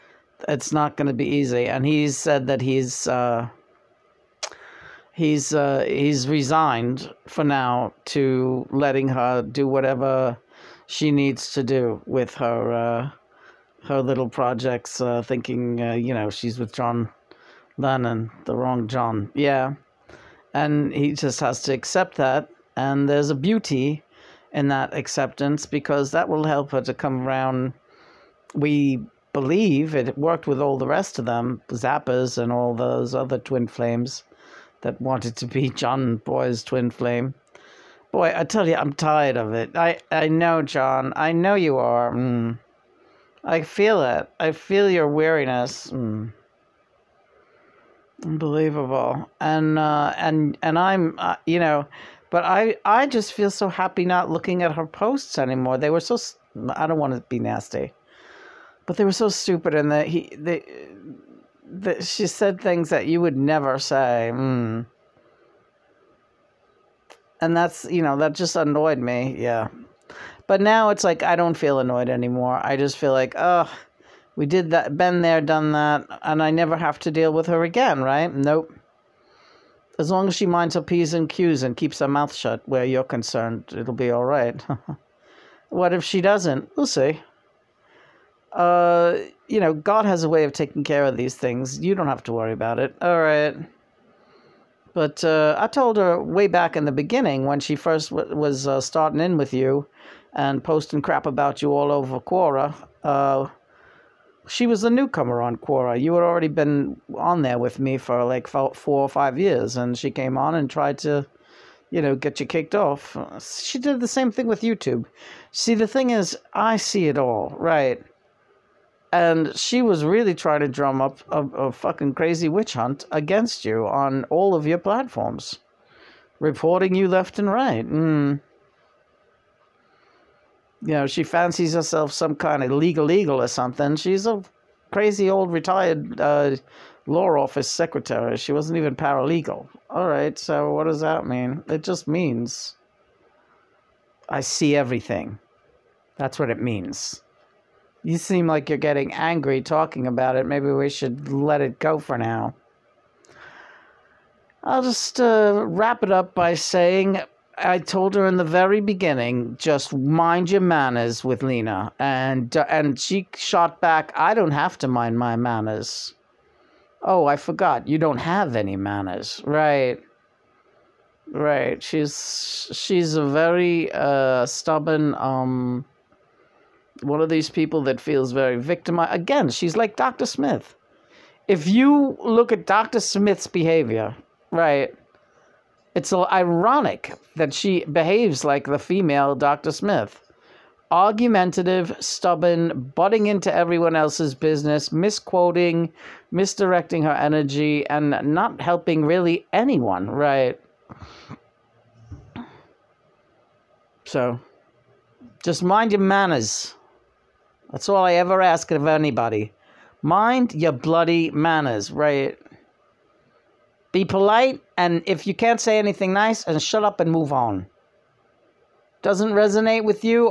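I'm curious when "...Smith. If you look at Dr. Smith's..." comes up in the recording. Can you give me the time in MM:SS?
03:00.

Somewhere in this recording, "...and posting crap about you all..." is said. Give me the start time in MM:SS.
01:40.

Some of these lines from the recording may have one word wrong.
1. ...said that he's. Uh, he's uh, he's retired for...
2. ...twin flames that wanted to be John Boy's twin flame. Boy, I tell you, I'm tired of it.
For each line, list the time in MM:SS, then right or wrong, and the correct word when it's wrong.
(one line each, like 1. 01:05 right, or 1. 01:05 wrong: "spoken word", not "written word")
1. 00:02 wrong: "resigned", not "retired"
2. 00:33 right.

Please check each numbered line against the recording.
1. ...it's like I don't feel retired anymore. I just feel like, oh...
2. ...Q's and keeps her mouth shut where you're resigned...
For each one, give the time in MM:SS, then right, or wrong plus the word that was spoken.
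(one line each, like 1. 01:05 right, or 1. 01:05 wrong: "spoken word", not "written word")
1. 01:10 wrong: "annoyed", not "retired"
2. 01:21 wrong: "concerned", not "resigned".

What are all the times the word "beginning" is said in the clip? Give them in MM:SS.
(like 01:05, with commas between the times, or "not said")
01:36, 02:38.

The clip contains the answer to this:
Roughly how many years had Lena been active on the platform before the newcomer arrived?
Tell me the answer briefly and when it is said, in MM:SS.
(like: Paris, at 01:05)
4 or 5 years, at 01:48.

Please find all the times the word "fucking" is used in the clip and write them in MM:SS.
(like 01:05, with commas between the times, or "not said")
02:01.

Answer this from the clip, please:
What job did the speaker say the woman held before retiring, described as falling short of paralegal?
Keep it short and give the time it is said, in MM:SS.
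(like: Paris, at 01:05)
Law office secretary, at 02:17.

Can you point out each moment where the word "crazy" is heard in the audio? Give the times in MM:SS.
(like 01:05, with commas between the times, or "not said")
02:02, 02:14.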